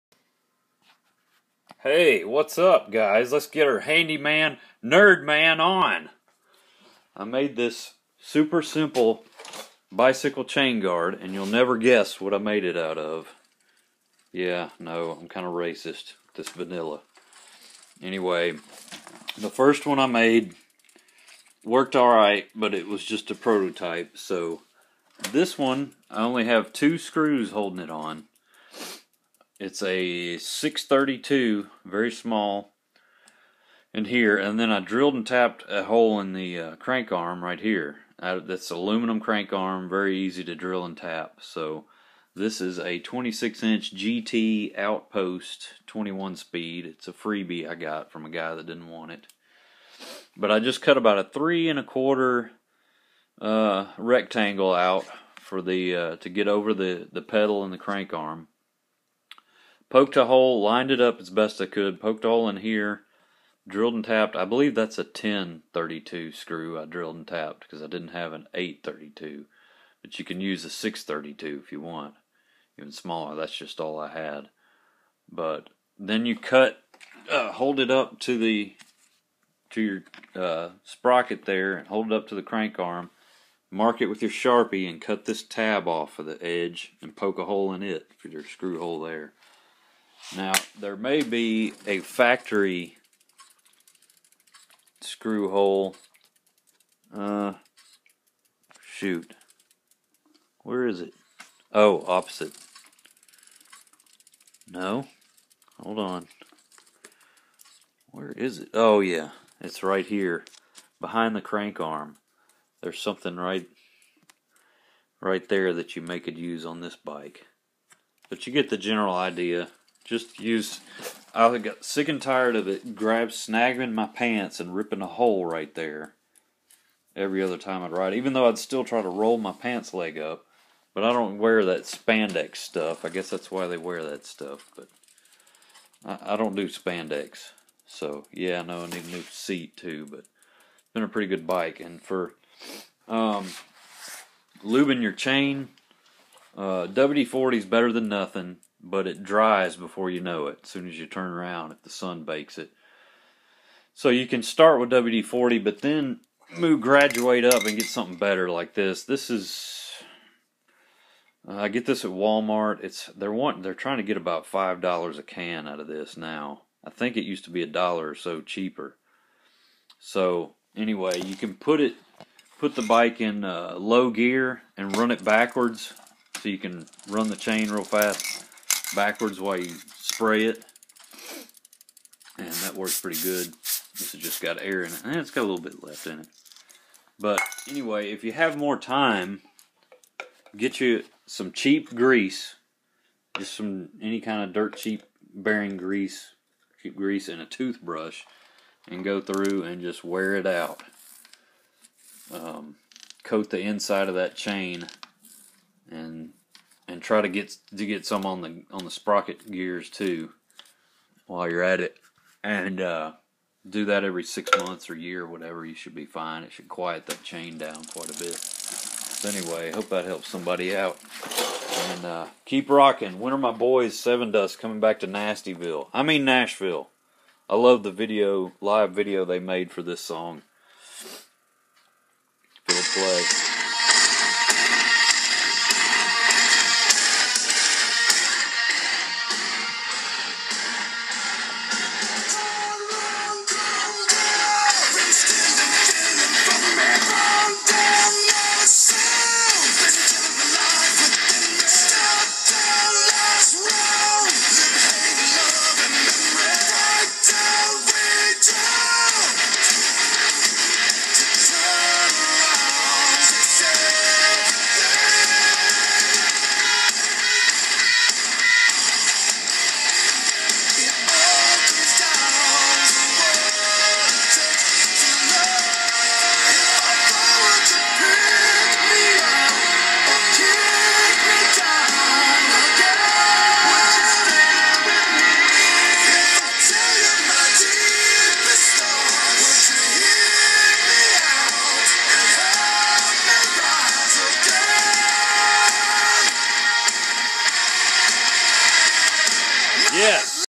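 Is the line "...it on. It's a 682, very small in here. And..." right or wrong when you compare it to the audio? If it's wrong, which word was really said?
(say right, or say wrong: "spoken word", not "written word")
wrong: "632", not "682".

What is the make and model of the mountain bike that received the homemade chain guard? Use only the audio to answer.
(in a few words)
GT Outpost.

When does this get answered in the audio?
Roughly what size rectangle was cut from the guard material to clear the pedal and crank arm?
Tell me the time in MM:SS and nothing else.
00:51.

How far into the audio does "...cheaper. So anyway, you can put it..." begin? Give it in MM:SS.
02:48.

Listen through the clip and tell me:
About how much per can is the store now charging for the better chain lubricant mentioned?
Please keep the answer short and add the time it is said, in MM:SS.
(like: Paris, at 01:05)
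5 dollars, at 02:44.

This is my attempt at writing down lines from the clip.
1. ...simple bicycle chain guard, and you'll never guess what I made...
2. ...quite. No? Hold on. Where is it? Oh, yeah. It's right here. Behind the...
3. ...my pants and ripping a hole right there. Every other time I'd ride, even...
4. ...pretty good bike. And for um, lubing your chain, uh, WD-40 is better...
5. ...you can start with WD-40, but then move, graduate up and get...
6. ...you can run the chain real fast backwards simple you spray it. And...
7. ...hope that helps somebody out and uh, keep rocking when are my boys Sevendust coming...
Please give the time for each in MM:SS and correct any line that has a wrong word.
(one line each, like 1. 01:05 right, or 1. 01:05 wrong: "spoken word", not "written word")
1. 00:08 right
2. 01:42 wrong: "opposite", not "quite"
3. 02:03 right
4. 02:21 right
5. 02:34 right
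6. 02:56 wrong: "while", not "simple"
7. 03:39 right.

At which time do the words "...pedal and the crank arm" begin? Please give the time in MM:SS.
00:57.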